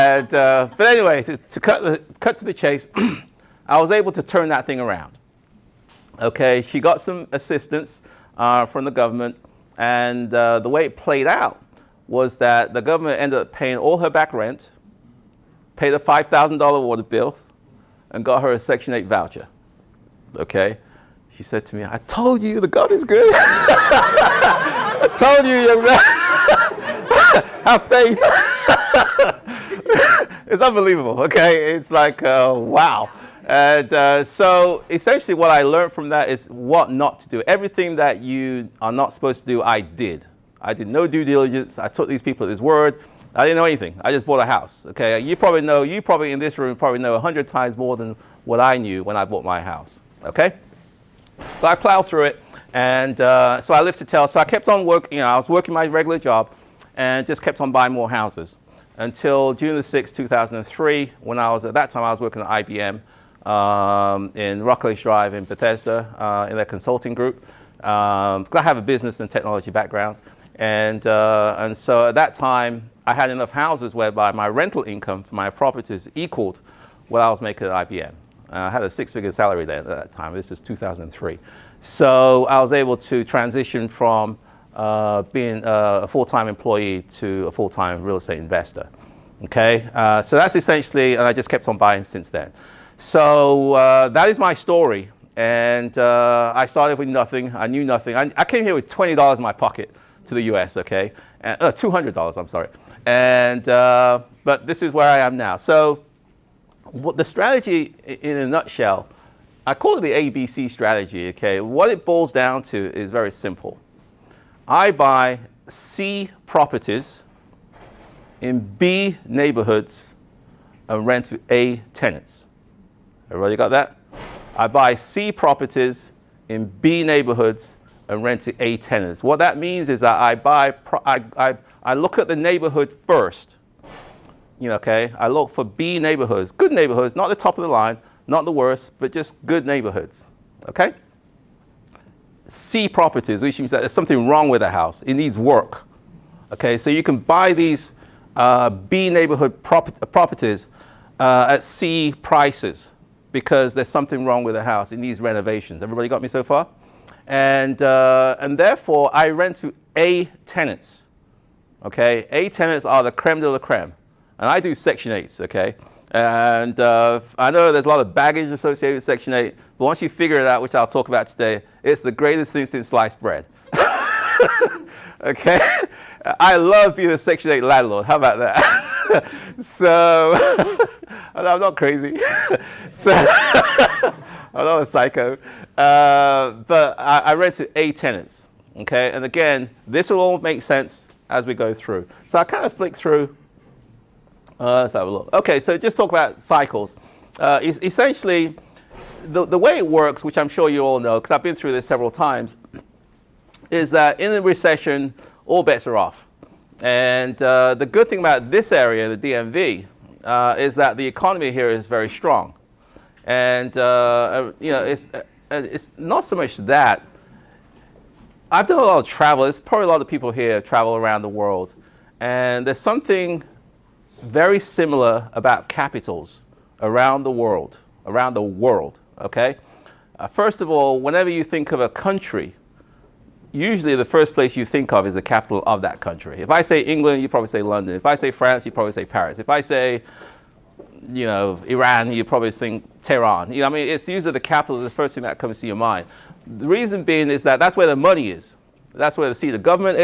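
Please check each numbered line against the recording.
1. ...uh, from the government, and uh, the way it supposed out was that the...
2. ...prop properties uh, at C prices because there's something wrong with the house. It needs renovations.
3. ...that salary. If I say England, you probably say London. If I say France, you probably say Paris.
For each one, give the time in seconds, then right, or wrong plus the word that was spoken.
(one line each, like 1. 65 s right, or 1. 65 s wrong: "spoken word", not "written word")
1. 8 s wrong: "played", not "supposed"
2. 149 s right
3. 235 s wrong: "country", not "salary".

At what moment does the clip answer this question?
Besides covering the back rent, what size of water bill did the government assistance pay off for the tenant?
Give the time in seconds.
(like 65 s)
15 s.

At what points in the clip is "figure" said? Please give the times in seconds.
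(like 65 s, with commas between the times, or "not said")
78 s, 170 s.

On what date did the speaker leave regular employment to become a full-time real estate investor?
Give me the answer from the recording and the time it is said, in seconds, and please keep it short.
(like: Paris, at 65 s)
June 6, 2003, at 59 s.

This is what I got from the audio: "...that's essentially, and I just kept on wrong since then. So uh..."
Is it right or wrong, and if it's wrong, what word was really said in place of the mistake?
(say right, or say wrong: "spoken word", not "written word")
wrong: "buying", not "wrong".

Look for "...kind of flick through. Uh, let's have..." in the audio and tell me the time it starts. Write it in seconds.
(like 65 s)
192 s.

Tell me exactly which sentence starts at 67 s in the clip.
Um, I have a business and technology background.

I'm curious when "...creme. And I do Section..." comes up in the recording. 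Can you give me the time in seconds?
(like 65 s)
163 s.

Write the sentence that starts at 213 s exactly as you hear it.
And, uh, uh you know, it's, uh, uh, it's not so much that.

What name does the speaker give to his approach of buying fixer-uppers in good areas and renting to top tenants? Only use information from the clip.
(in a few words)
ABC strategy.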